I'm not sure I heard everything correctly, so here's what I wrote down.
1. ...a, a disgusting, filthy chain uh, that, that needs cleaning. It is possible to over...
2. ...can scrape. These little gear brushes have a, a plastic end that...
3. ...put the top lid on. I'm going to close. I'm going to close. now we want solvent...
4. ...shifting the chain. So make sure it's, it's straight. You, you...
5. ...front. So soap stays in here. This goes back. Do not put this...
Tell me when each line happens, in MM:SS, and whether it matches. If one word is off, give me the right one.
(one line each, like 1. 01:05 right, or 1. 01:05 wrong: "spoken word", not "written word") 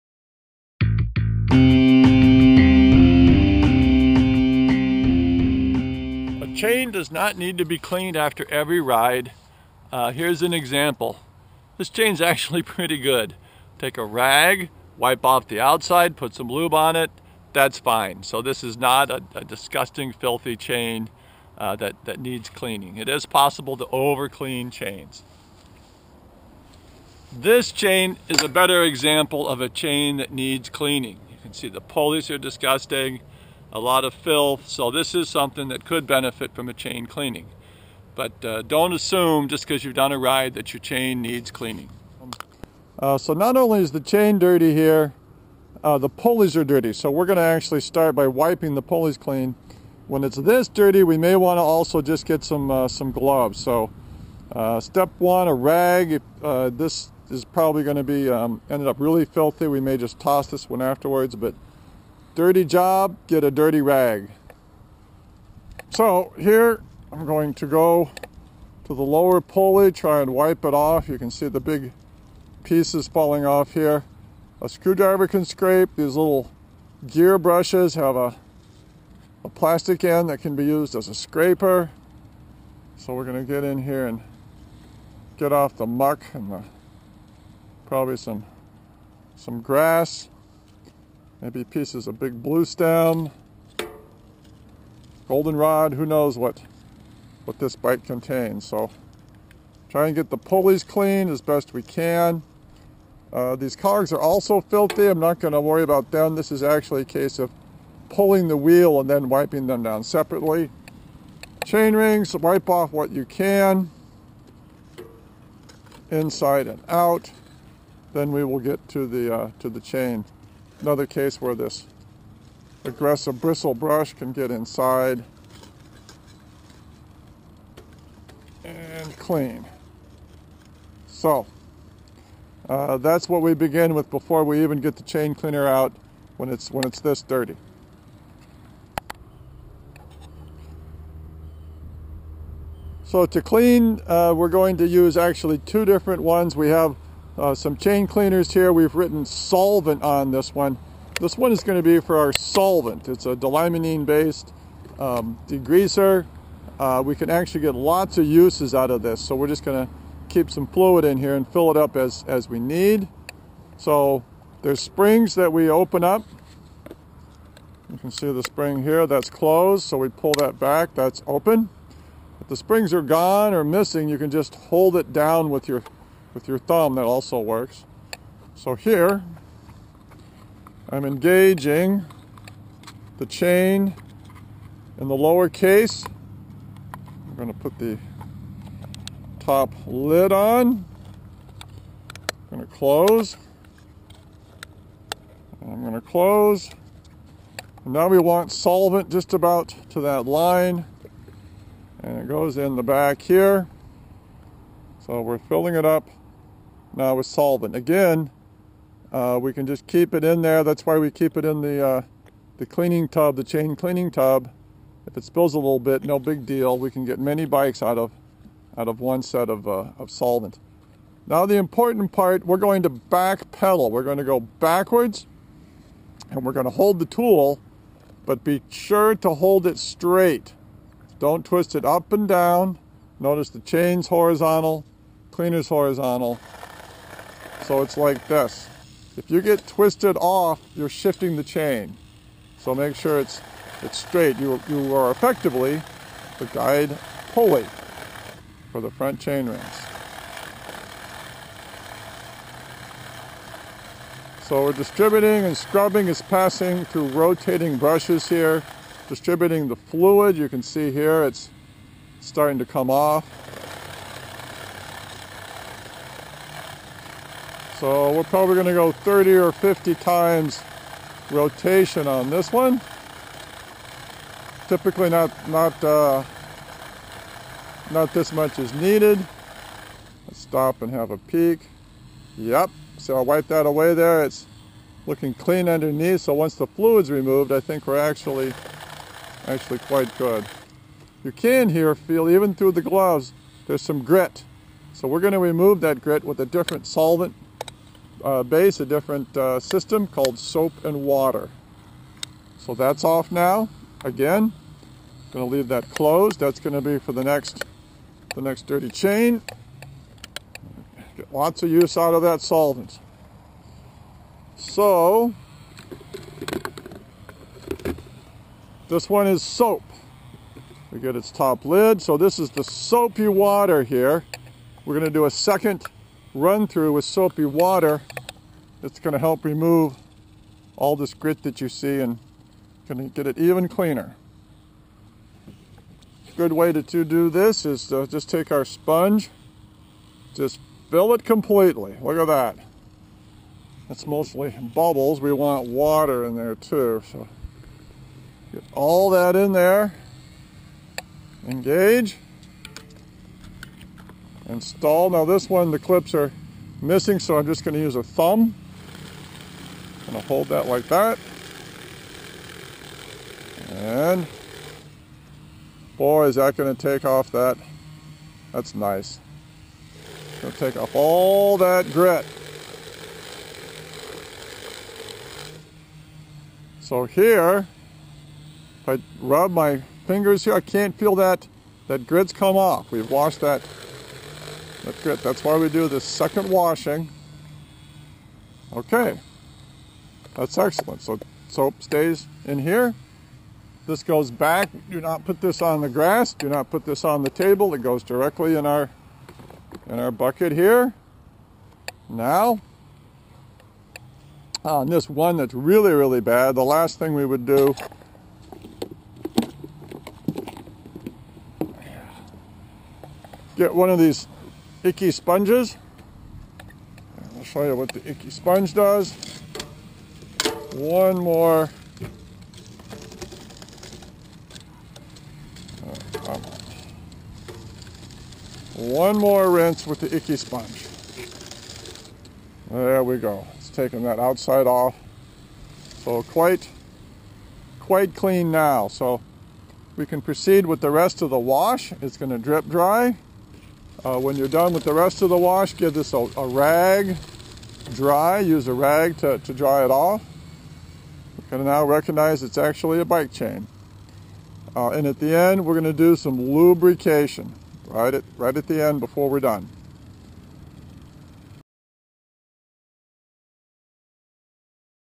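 1. 00:19 right
2. 01:15 right
3. 03:07 right
4. 04:00 right
5. 06:30 wrong: "excellent", not "front".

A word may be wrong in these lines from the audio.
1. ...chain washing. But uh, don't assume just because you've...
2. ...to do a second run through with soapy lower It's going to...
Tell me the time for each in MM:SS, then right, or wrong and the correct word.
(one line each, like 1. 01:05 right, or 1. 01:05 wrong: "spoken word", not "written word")
1. 00:36 wrong: "cleaning", not "washing"
2. 05:25 wrong: "water", not "lower".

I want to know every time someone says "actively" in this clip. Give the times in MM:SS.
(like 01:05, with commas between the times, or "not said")
not said.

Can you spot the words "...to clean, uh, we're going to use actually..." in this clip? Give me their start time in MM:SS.
02:23.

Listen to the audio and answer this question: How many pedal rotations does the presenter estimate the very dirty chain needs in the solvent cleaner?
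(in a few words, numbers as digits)
30 or 50.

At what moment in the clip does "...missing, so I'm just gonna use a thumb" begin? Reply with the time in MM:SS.
05:56.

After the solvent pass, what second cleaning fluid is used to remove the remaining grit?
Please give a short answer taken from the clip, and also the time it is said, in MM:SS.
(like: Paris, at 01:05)
Soap and water, at 05:00.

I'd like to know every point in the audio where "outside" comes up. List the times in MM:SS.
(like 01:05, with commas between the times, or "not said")
00:15, 07:14.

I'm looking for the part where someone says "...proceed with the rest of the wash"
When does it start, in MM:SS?
07:20.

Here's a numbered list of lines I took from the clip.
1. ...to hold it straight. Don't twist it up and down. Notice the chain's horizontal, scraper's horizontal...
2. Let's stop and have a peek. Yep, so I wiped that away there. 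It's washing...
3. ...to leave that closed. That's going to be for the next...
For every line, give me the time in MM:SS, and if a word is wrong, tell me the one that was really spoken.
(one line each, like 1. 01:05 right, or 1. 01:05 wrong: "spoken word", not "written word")
1. 03:49 wrong: "cleaner", not "scraper"
2. 04:40 wrong: "looking", not "washing"
3. 05:05 right.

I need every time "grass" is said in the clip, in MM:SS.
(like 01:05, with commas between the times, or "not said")
01:29, 06:35.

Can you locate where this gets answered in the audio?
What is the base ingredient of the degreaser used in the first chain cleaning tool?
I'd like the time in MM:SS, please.
02:33.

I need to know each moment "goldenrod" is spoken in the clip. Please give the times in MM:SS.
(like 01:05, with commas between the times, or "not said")
01:35.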